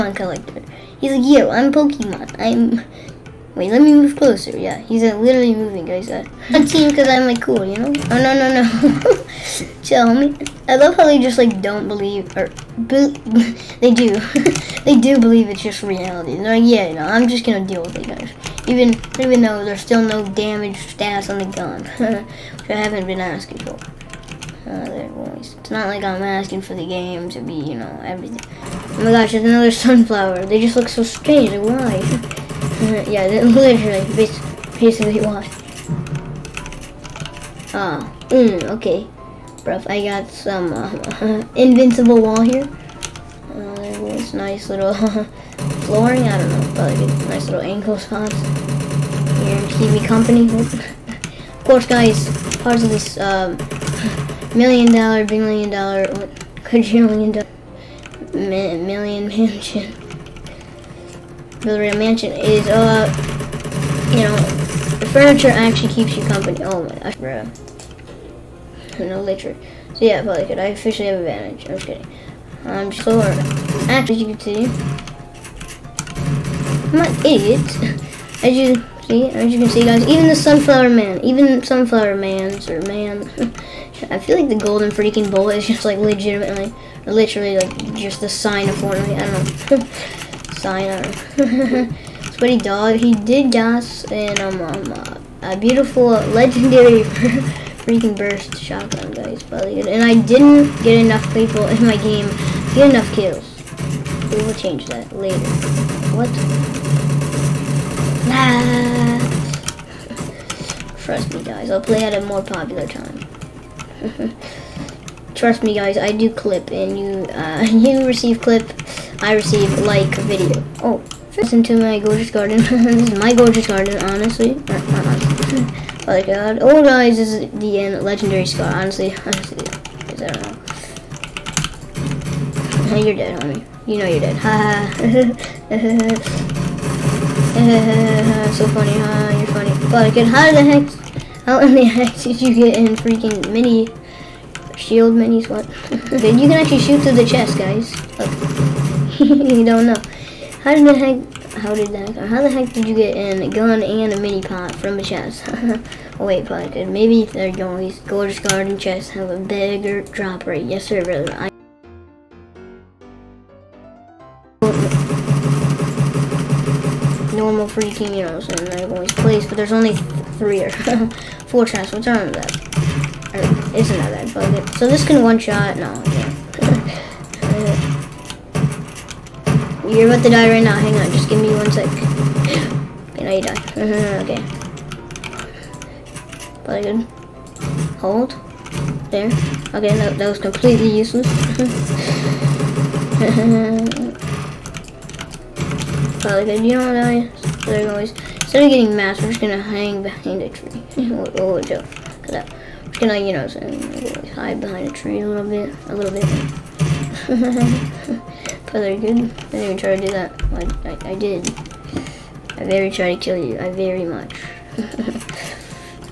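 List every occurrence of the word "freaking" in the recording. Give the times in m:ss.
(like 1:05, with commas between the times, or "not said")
1:24, 1:37, 2:22, 2:47.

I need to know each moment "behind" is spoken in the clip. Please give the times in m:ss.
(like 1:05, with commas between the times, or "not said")
3:20, 3:24.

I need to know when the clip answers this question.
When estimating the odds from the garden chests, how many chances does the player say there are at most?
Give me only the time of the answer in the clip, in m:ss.
2:51.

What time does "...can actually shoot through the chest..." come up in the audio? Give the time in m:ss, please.
2:26.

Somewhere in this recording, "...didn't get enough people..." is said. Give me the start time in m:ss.
1:40.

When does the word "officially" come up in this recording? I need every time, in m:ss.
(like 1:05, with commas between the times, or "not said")
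1:10.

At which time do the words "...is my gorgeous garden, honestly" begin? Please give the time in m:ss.
2:03.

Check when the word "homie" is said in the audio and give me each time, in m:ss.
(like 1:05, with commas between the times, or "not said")
0:10, 2:13.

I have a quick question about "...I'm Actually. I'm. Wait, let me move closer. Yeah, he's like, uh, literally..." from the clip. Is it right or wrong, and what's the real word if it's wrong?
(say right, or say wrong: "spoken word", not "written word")
wrong: "Pokemon", not "Actually".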